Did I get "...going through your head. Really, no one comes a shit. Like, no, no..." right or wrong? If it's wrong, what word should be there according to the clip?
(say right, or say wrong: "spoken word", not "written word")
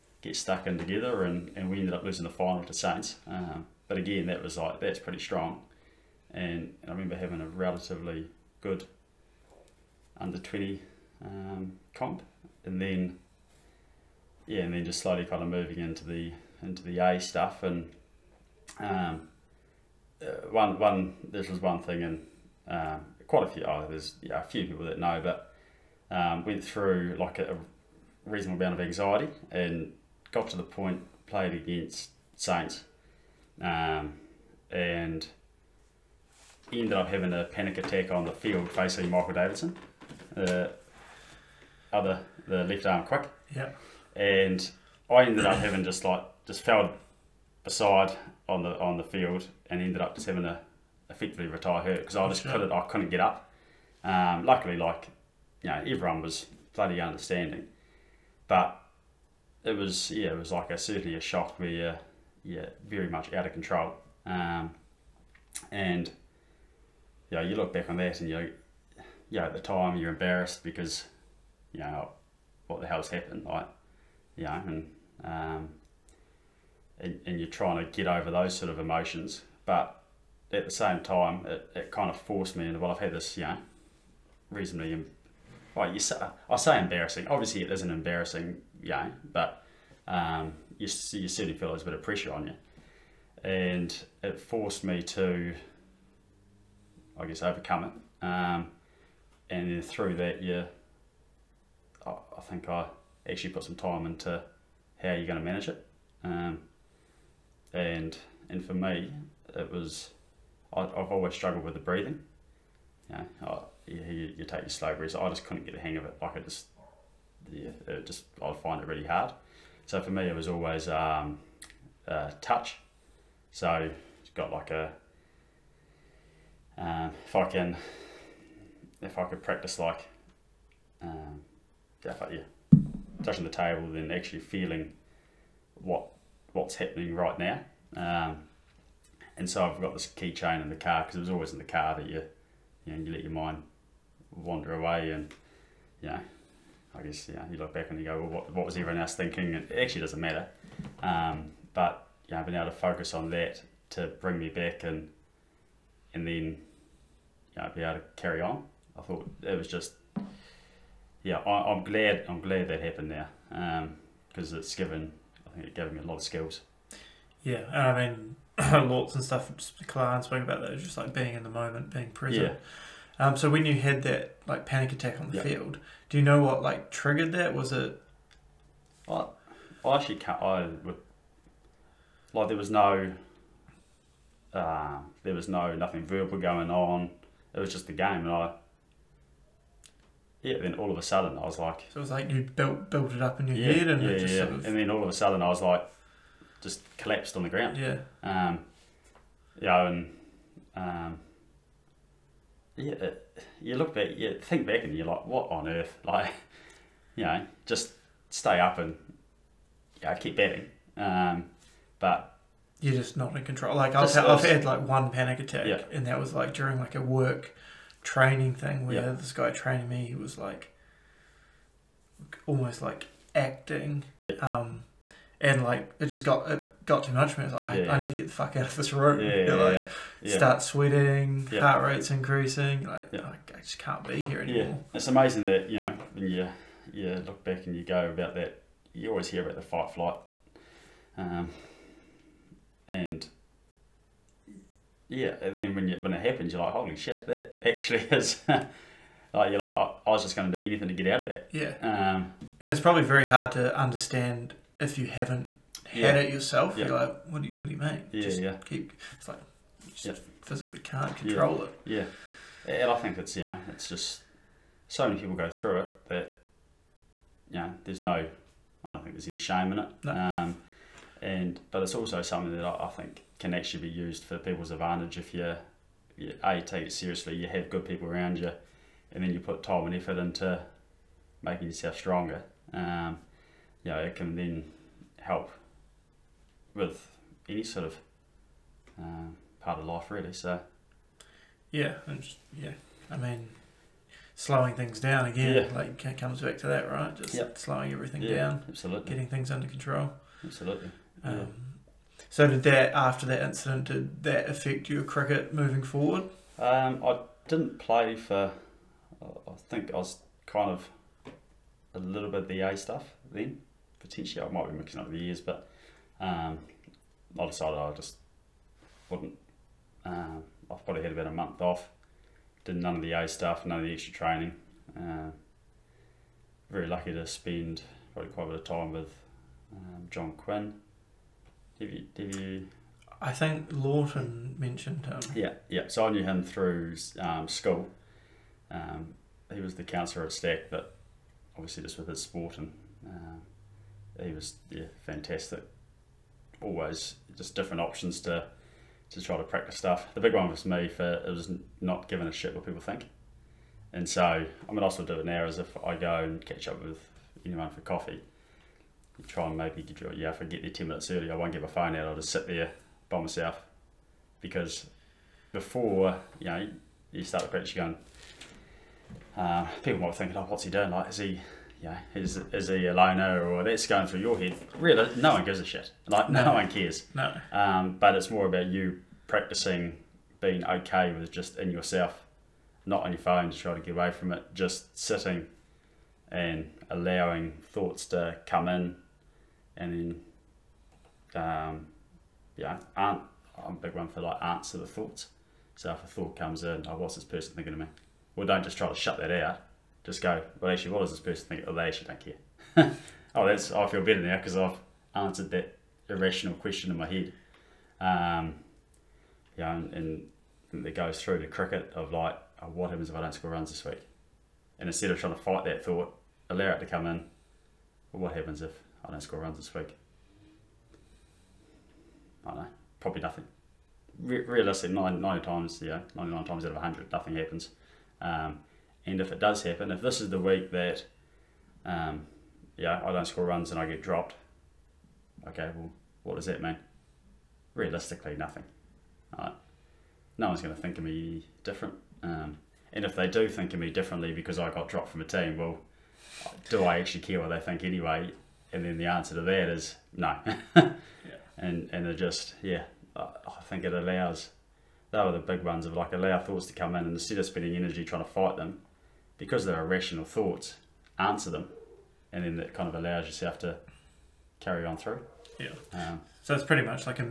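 wrong: "gives", not "comes".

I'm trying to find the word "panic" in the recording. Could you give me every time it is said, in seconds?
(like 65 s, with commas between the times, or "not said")
37 s, 174 s, 215 s.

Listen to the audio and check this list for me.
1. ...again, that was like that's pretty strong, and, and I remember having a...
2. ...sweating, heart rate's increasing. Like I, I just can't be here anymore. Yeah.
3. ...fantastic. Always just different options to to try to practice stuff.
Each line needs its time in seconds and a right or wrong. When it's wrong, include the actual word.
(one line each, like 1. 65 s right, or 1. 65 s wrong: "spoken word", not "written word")
1. 3 s right
2. 230 s right
3. 345 s right.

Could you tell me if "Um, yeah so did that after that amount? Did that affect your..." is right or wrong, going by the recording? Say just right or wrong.
wrong.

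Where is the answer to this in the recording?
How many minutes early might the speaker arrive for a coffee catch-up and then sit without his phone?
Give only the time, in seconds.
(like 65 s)
360 s.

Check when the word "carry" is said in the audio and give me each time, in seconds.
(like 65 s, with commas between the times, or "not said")
158 s, 464 s.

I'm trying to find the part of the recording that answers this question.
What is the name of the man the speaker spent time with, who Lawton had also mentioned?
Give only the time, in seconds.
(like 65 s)
330 s.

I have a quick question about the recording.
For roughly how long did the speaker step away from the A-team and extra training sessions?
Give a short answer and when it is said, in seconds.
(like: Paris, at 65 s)
about a month, at 321 s.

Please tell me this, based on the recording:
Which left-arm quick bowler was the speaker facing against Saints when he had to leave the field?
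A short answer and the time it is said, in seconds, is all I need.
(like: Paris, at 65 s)
Michael Davidson, at 39 s.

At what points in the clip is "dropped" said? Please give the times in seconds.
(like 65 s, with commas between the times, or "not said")
434 s, 444 s.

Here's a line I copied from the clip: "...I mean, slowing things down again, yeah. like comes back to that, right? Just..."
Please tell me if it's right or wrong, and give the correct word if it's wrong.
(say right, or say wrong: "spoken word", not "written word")
right.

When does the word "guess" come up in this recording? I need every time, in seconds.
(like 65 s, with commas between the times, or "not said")
97 s, 147 s.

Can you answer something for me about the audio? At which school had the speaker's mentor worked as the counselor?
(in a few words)
StAC.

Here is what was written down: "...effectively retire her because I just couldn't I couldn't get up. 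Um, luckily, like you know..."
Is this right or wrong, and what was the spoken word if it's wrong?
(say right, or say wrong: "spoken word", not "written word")
right.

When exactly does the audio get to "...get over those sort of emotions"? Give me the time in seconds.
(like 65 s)
77 s.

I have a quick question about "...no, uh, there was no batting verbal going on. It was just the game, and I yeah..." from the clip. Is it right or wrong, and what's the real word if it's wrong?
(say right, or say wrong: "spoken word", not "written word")
wrong: "nothing", not "batting".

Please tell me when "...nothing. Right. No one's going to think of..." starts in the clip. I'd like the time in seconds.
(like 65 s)
438 s.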